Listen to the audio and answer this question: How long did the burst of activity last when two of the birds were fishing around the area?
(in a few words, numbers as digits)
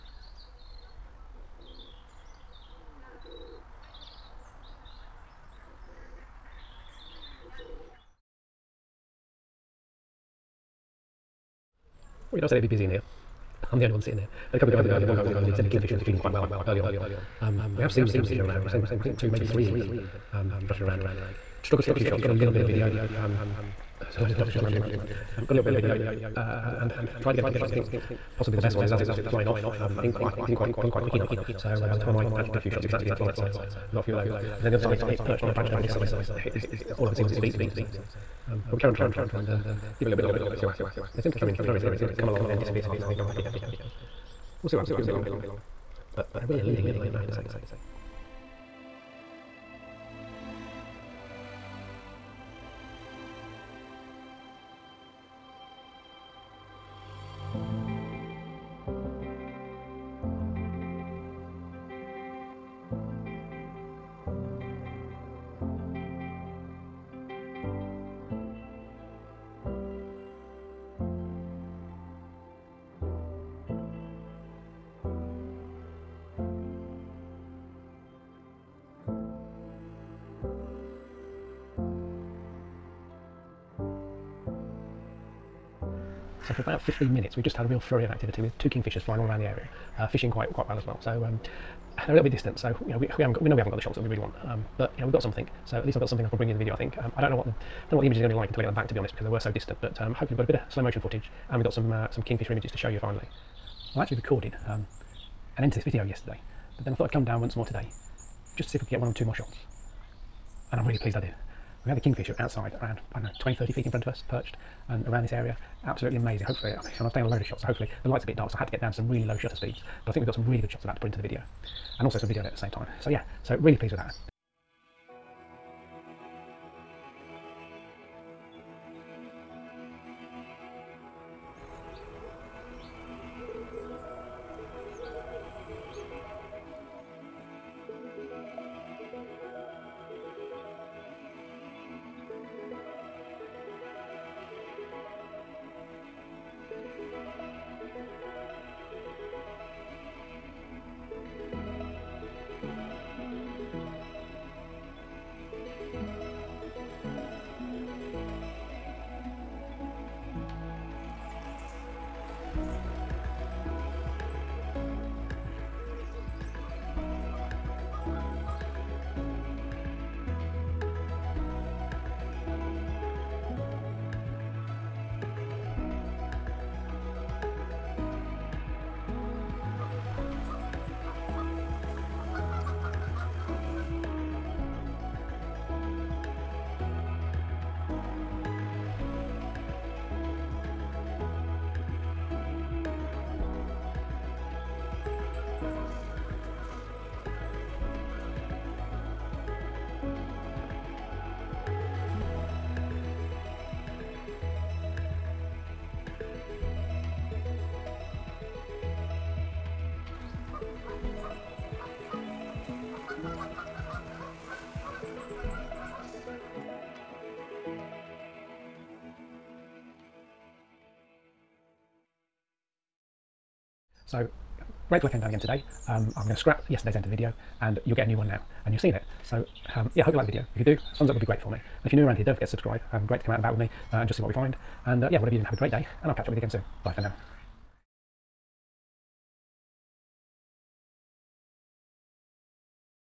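about 15 minutes.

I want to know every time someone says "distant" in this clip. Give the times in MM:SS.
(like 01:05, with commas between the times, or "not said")
01:32, 01:39.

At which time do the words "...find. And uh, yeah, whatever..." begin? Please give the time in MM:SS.
03:54.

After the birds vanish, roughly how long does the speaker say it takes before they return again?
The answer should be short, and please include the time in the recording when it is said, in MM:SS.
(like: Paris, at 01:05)
half an hour, at 00:42.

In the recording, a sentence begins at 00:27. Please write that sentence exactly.
I think possibly the best one is as it was flying off.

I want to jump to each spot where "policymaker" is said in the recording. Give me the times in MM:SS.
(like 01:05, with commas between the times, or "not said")
not said.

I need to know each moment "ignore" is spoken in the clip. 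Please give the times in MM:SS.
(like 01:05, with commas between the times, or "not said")
not said.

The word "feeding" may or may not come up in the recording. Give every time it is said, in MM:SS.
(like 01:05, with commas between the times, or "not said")
00:16.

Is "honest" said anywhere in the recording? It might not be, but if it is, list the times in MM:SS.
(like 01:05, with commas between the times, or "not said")
00:37, 01:38.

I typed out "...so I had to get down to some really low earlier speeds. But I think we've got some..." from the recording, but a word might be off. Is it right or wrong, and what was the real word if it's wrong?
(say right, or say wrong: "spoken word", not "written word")
wrong: "shutter", not "earlier".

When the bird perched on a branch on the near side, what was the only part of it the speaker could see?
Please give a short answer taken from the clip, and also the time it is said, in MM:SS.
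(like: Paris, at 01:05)
its feet, at 00:37.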